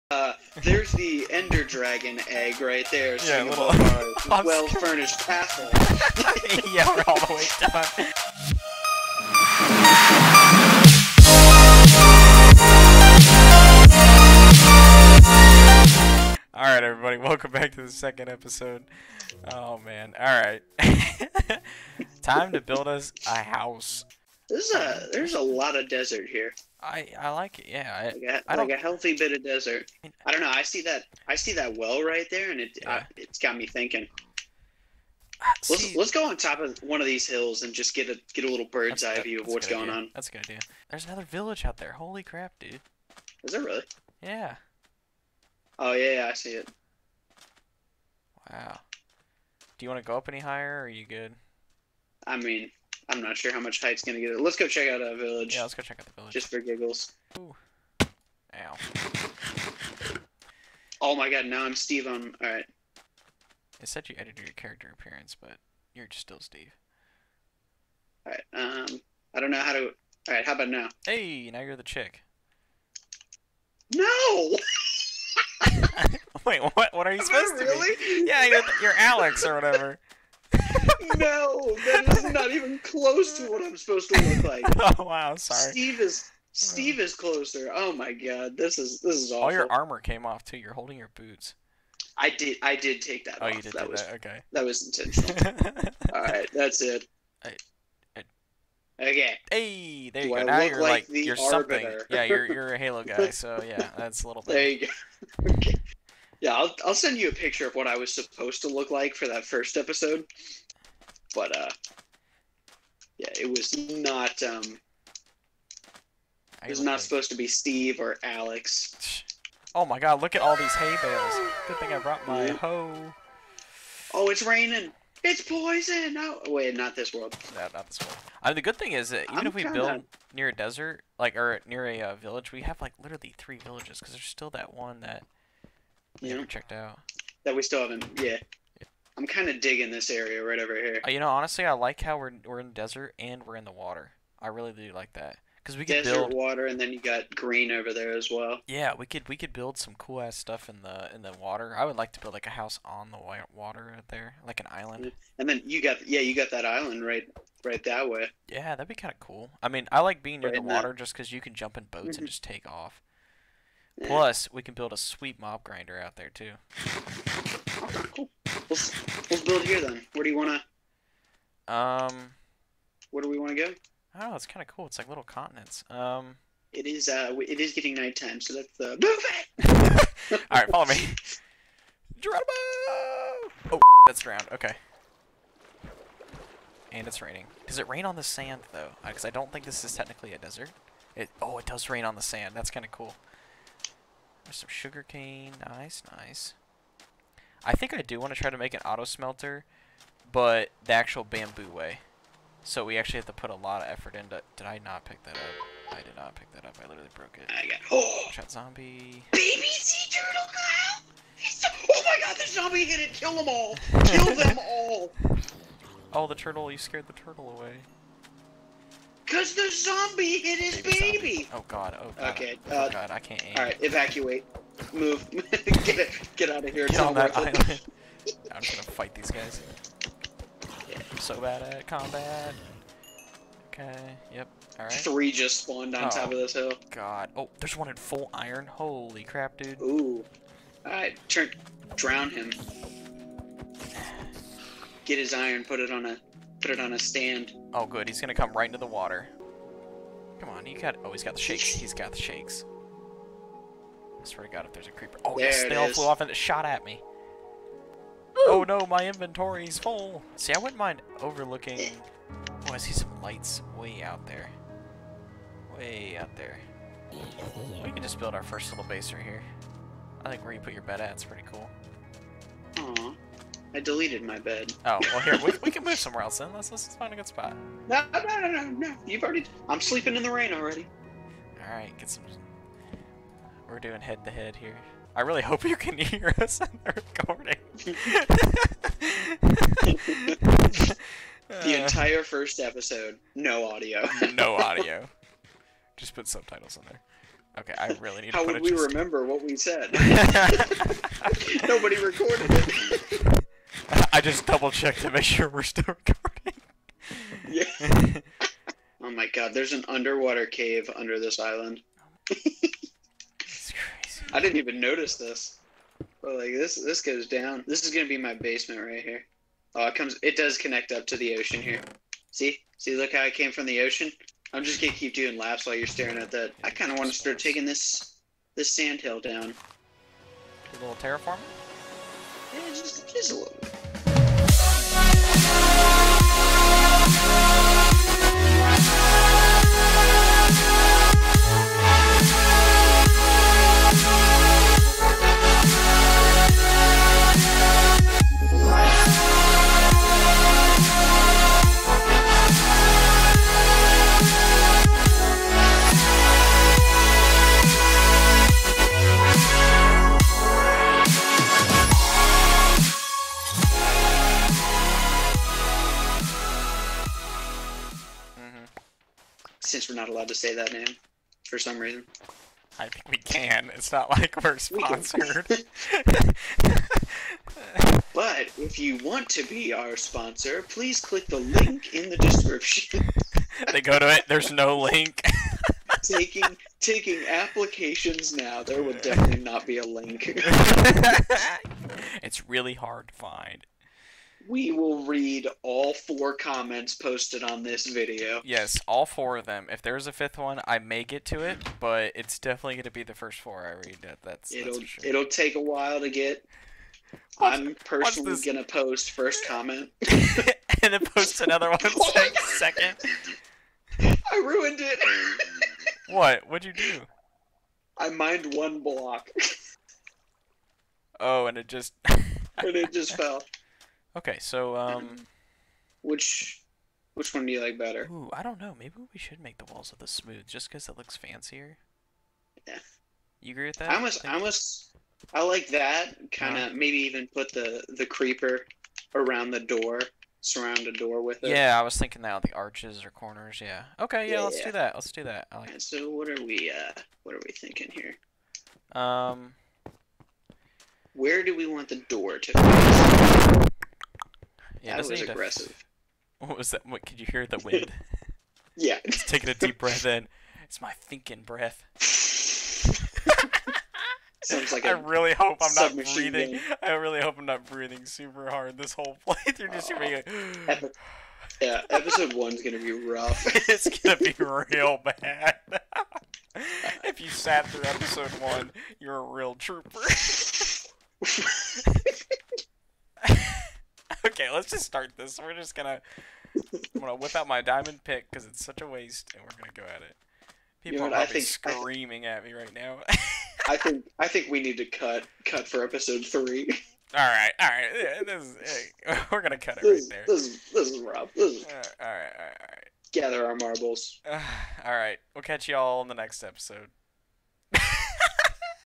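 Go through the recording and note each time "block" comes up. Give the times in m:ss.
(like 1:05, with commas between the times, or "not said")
6:58.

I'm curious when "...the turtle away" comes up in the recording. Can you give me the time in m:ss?
3:37.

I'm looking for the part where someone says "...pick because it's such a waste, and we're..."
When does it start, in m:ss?
8:08.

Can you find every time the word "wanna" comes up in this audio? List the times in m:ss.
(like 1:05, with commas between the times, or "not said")
2:50, 5:26.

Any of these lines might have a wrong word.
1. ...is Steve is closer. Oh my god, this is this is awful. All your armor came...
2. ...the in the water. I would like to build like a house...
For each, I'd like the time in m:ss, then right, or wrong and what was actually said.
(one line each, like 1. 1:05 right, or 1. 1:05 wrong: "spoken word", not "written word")
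1. 1:26 right
2. 2:30 right.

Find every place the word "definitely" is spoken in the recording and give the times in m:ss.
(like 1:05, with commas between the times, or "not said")
6:28, 6:42.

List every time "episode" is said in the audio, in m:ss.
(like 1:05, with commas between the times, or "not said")
0:18, 1:49, 4:52, 7:51, 7:57, 8:15, 8:26.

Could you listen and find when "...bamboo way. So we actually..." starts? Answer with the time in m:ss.
3:21.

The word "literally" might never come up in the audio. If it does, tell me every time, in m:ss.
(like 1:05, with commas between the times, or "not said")
2:13, 3:26.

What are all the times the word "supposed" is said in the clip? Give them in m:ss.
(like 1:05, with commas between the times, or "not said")
1:17, 1:23, 1:48, 1:57.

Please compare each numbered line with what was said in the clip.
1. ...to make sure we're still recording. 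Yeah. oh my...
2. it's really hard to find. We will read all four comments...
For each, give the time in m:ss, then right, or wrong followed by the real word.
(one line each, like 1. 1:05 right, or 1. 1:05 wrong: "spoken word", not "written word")
1. 5:05 right
2. 6:32 right.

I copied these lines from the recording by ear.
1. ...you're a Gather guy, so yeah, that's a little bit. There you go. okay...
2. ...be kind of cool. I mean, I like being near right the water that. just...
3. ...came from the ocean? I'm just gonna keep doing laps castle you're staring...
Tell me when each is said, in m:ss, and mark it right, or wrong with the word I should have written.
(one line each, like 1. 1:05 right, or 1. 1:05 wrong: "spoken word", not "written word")
1. 1:42 wrong: "Halo", not "Gather"
2. 2:38 right
3. 5:23 wrong: "while", not "castle".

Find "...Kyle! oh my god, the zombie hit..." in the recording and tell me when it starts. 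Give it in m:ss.
3:30.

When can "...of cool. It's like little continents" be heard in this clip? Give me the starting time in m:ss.
2:54.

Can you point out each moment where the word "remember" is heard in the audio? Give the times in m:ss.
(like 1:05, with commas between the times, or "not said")
4:58.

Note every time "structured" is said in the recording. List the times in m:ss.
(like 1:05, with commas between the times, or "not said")
not said.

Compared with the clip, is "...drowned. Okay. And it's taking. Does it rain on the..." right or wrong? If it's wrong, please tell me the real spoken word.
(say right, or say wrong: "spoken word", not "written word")
wrong: "raining", not "taking".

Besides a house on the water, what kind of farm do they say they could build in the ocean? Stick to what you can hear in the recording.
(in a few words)
mob grinder.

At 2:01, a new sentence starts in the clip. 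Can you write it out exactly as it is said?
Good thing I brought my yeah.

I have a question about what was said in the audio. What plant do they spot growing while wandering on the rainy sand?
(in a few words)
sugarcane.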